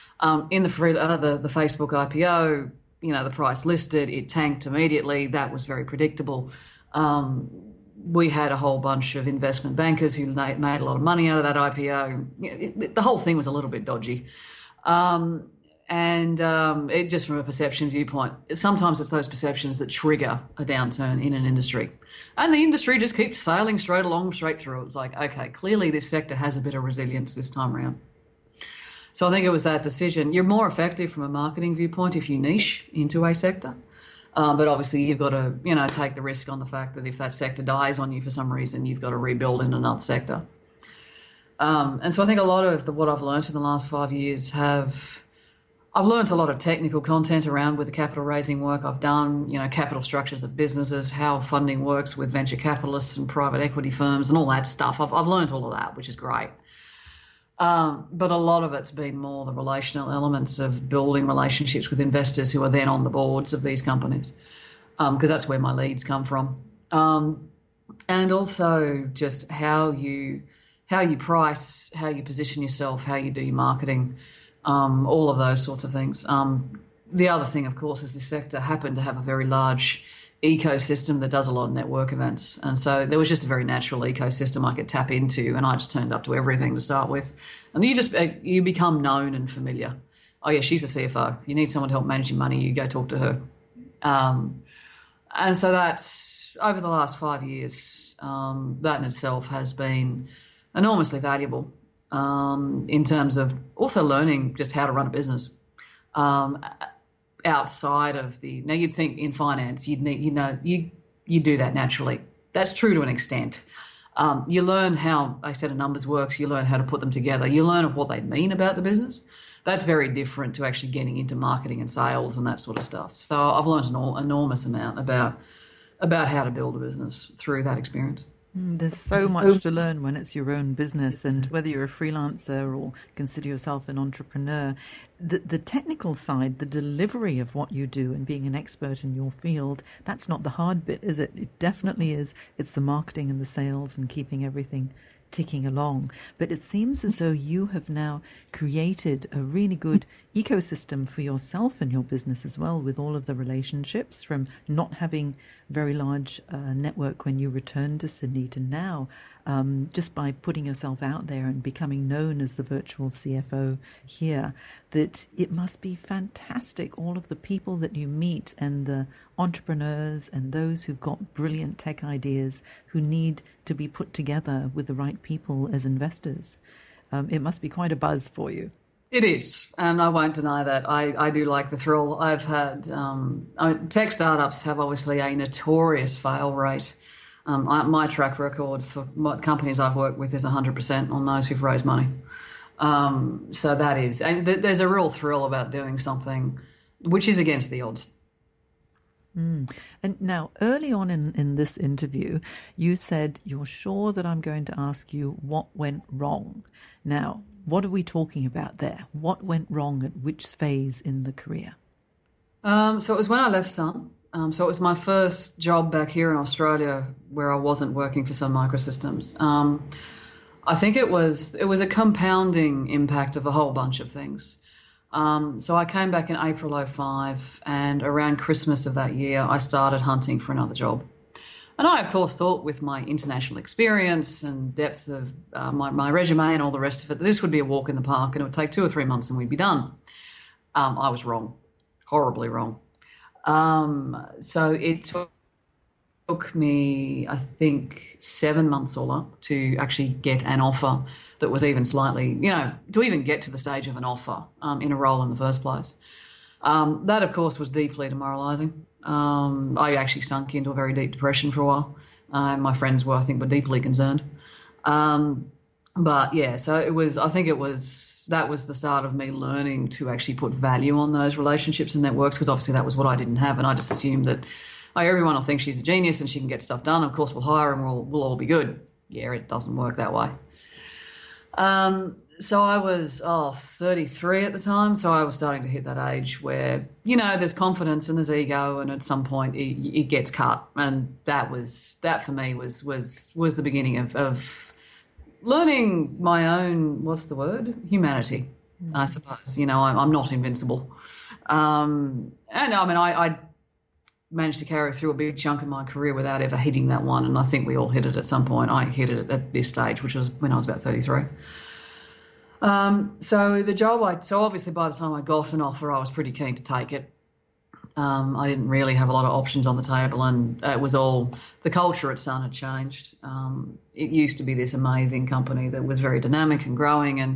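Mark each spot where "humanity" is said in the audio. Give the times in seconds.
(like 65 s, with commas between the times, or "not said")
297 s.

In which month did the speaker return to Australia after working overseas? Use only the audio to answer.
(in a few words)
April.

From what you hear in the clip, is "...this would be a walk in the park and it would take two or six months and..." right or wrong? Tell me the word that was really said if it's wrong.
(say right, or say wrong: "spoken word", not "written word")
wrong: "three", not "six".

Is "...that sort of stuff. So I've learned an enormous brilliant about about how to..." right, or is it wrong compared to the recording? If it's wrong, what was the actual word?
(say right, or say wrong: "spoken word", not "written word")
wrong: "amount", not "brilliant".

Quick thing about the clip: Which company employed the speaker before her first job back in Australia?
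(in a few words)
Sun Microsystems.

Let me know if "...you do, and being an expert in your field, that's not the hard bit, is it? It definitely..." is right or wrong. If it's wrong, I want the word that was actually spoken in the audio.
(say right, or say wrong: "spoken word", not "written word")
right.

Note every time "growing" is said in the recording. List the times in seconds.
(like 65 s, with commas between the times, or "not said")
326 s.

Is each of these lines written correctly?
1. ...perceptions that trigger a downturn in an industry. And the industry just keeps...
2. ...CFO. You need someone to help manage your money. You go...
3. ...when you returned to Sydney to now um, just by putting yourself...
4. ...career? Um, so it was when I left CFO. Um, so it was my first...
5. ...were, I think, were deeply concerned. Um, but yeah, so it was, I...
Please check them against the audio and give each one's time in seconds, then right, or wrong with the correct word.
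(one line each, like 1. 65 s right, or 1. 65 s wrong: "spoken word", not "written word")
1. 19 s right
2. 91 s right
3. 157 s right
4. 211 s wrong: "Sun", not "CFO"
5. 263 s right.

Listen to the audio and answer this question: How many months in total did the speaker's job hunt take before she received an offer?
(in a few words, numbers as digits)
7.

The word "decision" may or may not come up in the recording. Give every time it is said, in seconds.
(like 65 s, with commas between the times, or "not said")
29 s.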